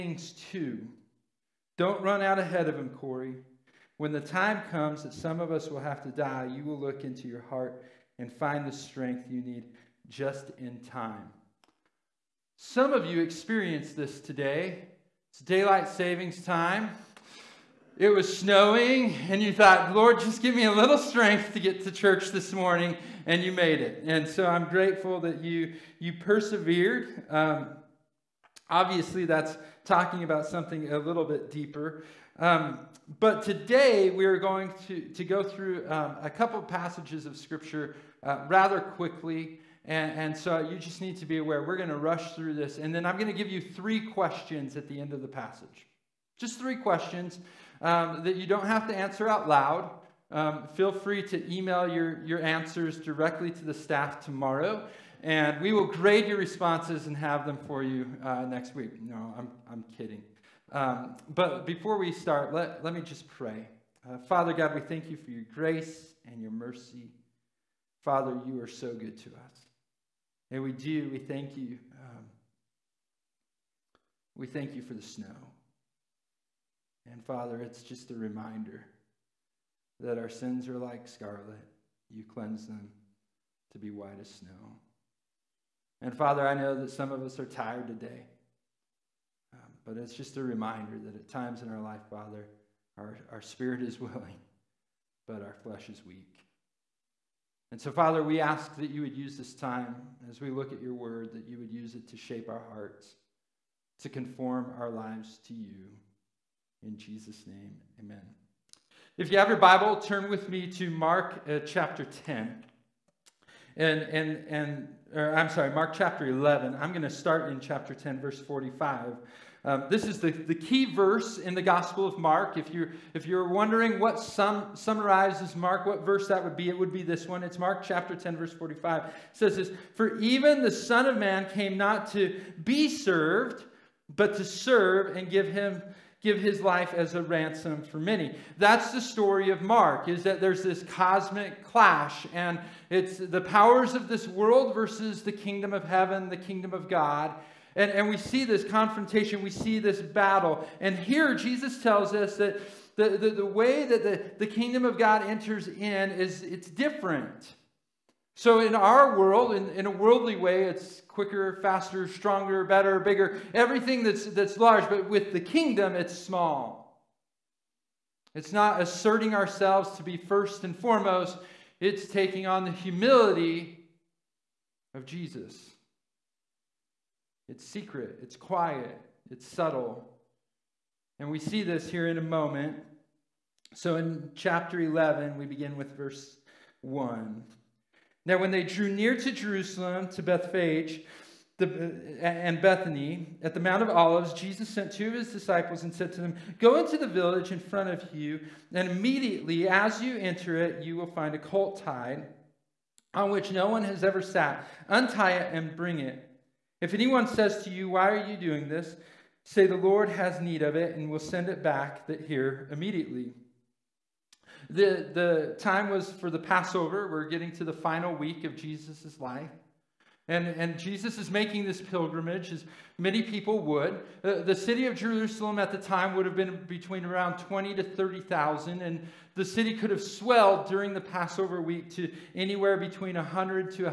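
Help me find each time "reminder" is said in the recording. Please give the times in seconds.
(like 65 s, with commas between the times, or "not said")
78 s, 90 s.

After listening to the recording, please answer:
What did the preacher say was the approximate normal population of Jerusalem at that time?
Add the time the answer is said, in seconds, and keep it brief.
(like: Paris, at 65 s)
20,000 to 30,000, at 226 s.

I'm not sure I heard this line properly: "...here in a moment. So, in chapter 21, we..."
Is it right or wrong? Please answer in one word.
wrong.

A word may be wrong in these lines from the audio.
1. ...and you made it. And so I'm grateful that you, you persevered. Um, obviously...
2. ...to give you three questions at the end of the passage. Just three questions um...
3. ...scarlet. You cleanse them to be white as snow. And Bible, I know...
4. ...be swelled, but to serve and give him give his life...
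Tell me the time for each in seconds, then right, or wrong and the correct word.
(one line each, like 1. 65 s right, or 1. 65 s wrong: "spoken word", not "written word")
1. 23 s right
2. 43 s right
3. 81 s wrong: "Father", not "Bible"
4. 132 s wrong: "served", not "swelled".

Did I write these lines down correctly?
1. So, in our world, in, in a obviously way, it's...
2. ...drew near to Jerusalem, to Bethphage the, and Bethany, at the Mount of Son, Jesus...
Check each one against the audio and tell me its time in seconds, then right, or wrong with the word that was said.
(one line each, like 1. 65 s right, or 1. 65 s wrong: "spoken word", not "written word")
1. 158 s wrong: "worldly", not "obviously"
2. 188 s wrong: "Olives", not "Son".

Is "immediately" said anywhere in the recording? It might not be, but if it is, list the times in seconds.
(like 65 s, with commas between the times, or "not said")
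198 s, 212 s.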